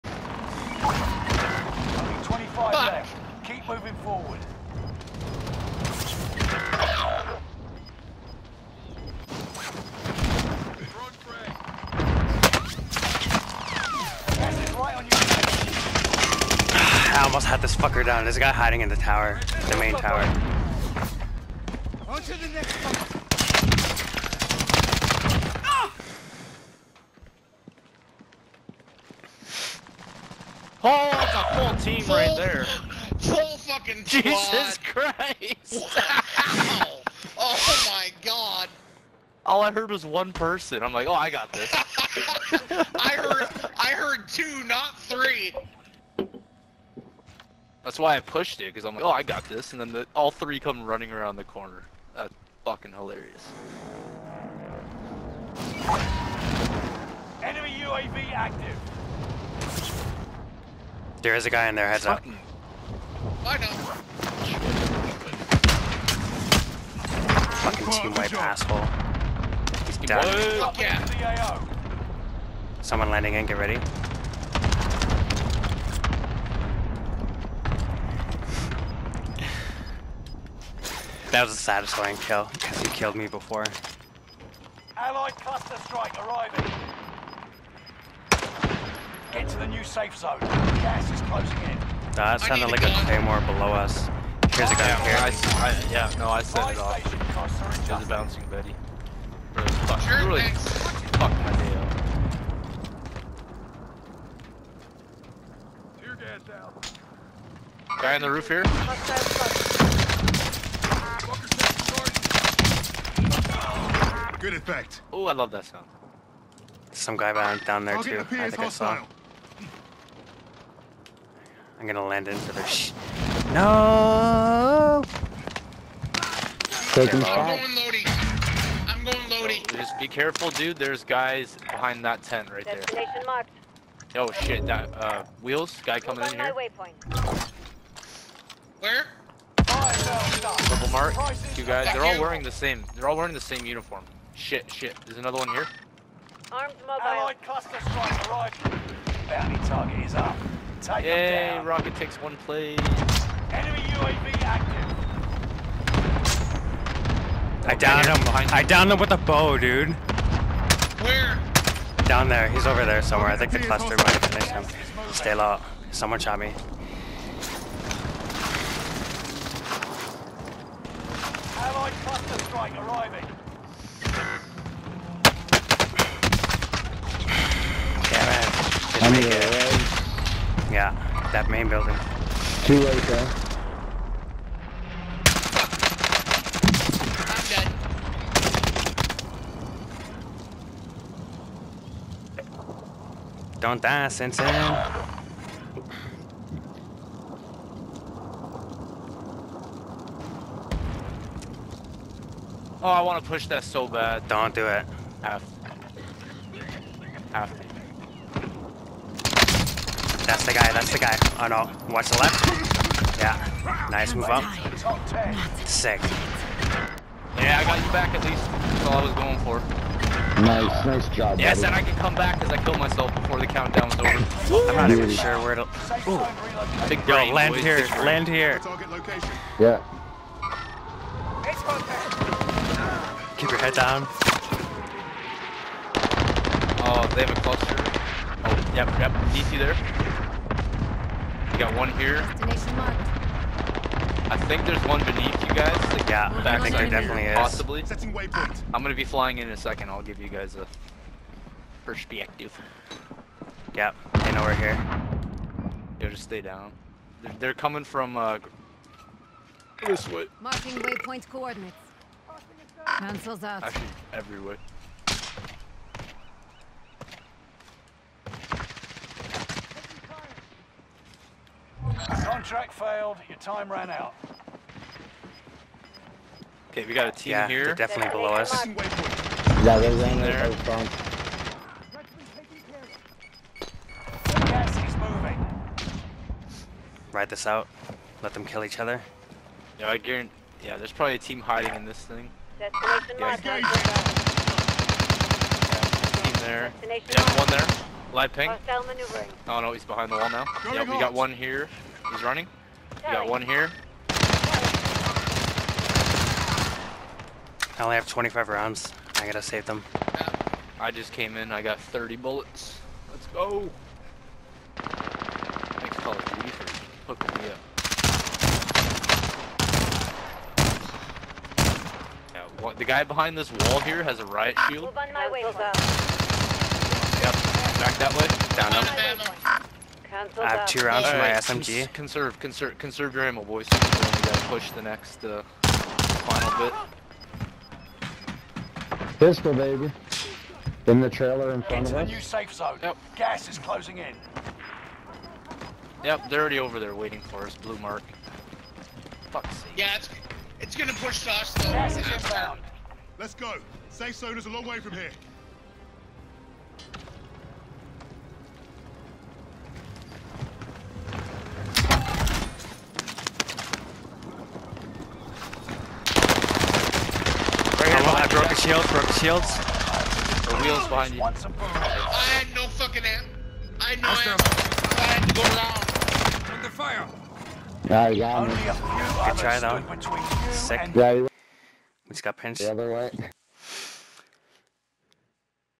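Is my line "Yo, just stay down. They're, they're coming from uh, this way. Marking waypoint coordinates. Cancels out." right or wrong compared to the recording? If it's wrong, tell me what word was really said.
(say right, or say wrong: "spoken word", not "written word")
right.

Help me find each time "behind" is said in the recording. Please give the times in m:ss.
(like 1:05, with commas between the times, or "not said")
2:11, 4:59, 5:23, 6:10.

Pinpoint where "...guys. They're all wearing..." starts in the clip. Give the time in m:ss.
2:21.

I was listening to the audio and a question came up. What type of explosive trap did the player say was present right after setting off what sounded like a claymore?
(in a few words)
bouncing Betty.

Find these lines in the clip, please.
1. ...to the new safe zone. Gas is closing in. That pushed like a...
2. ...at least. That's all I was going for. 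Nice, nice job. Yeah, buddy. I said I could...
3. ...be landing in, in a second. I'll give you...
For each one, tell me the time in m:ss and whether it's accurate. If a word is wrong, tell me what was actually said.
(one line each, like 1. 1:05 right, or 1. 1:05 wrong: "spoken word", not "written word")
1. 1:29 wrong: "sounded", not "pushed"
2. 3:38 right
3. 4:08 wrong: "flying", not "landing".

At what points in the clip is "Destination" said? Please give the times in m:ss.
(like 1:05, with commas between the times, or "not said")
2:12, 4:02, 4:52.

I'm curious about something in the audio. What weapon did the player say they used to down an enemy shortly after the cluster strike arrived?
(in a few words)
a bow.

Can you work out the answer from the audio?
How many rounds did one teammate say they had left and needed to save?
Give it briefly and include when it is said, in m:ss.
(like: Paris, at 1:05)
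25, at 5:08.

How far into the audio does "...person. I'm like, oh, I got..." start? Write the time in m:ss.
0:40.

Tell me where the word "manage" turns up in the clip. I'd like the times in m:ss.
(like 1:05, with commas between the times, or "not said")
not said.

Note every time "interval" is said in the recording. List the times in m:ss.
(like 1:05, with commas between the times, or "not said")
not said.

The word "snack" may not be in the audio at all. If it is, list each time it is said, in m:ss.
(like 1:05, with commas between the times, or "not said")
not said.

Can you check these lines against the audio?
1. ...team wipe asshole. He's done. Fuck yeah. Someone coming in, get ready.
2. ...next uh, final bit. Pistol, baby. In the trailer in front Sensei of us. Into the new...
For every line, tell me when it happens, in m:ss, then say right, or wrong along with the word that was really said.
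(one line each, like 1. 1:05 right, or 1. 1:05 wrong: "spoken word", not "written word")
1. 1:07 wrong: "landing", not "coming"
2. 5:34 wrong: "Into", not "Sensei".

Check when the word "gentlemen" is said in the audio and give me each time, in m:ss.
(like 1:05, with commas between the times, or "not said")
not said.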